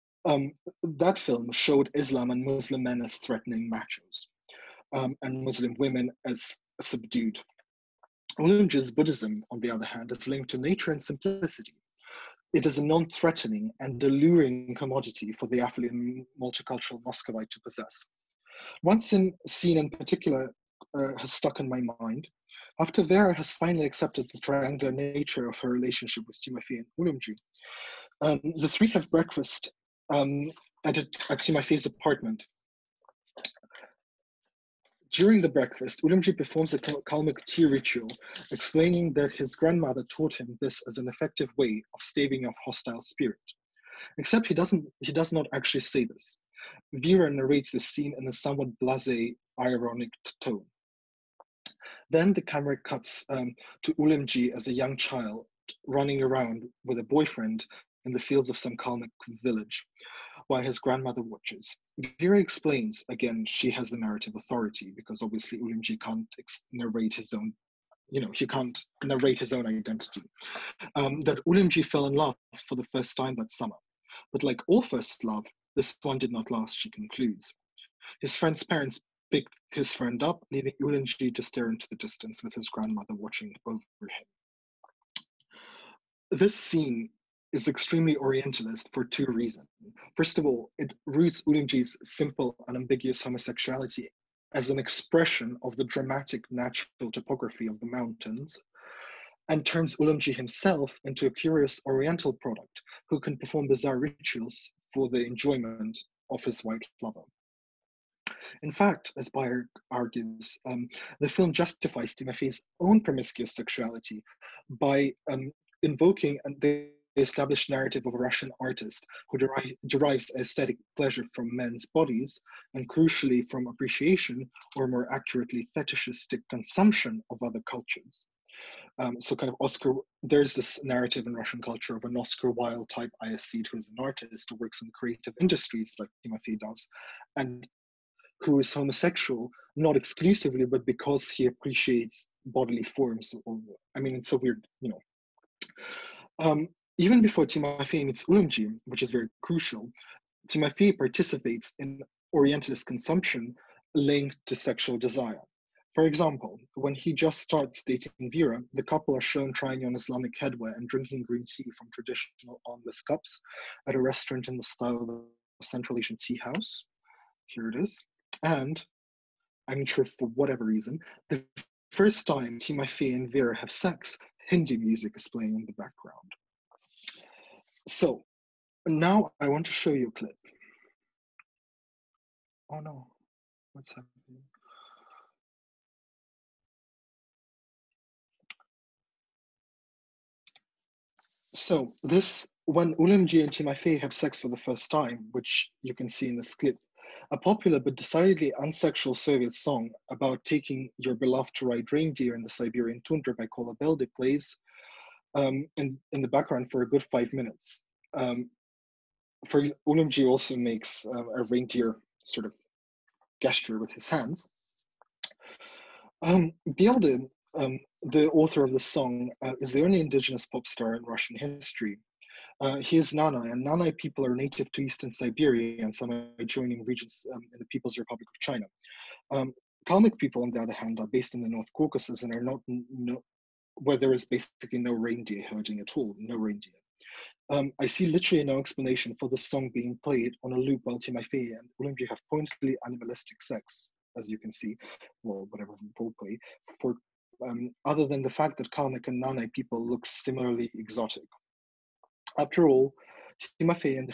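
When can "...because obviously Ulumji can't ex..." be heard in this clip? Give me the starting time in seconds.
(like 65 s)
64 s.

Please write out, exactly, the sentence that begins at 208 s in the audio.
Um, for Ulumji also makes um, a reindeer sort of gesture with his hands.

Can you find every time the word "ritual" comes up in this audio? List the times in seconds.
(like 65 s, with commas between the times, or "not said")
37 s, 103 s.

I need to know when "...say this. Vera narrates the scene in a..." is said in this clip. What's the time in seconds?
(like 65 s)
45 s.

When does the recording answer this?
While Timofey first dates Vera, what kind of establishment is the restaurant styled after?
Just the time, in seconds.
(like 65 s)
165 s.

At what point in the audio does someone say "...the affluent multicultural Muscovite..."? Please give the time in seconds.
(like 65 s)
15 s.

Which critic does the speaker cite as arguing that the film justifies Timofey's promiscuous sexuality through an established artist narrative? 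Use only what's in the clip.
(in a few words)
Bayer.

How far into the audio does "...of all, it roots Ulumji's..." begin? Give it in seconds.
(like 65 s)
90 s.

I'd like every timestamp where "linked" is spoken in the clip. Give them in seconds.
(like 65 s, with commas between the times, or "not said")
10 s, 153 s.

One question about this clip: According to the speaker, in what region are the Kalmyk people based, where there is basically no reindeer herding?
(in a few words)
North Caucasus.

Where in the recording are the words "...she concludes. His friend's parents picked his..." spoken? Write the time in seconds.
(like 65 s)
76 s.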